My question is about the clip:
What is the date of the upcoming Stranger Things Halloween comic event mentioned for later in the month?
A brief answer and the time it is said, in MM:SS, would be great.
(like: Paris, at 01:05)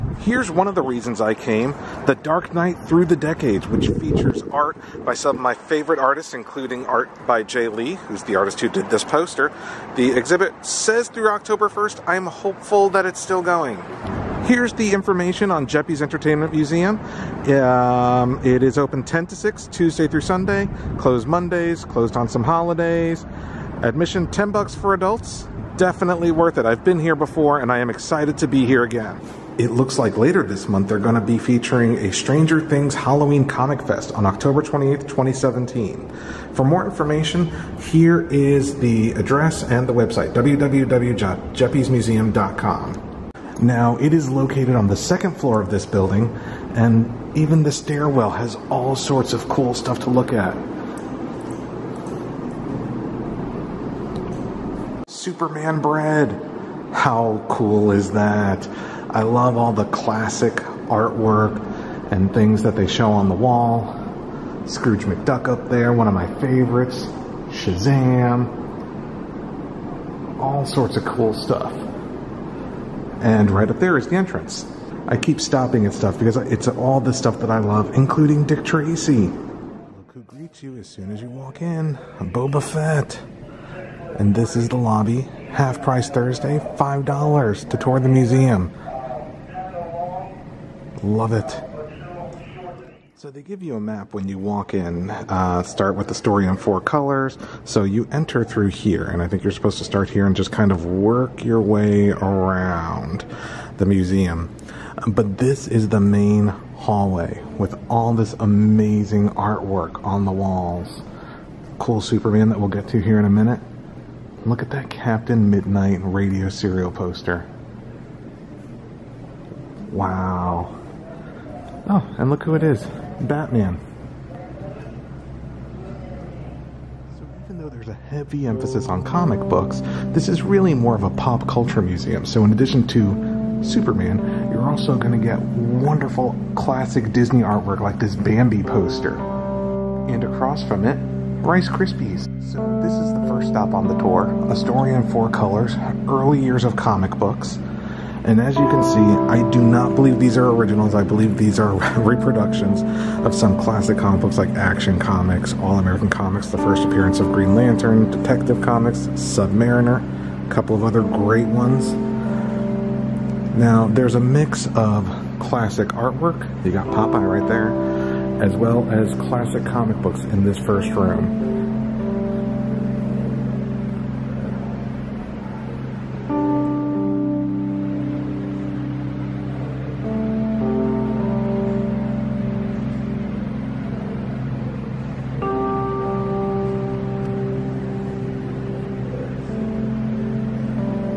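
October 28th, 2017, at 00:34.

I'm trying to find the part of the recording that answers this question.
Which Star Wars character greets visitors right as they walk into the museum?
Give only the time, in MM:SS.
01:22.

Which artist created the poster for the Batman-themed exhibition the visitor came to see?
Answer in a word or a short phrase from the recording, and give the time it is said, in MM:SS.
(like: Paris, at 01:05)
Jay Lee, at 00:07.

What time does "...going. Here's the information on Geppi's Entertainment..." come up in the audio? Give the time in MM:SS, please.
00:13.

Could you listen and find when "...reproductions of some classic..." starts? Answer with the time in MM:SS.
02:32.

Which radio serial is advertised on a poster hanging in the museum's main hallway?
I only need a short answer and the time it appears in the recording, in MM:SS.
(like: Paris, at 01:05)
Captain Midnight, at 01:54.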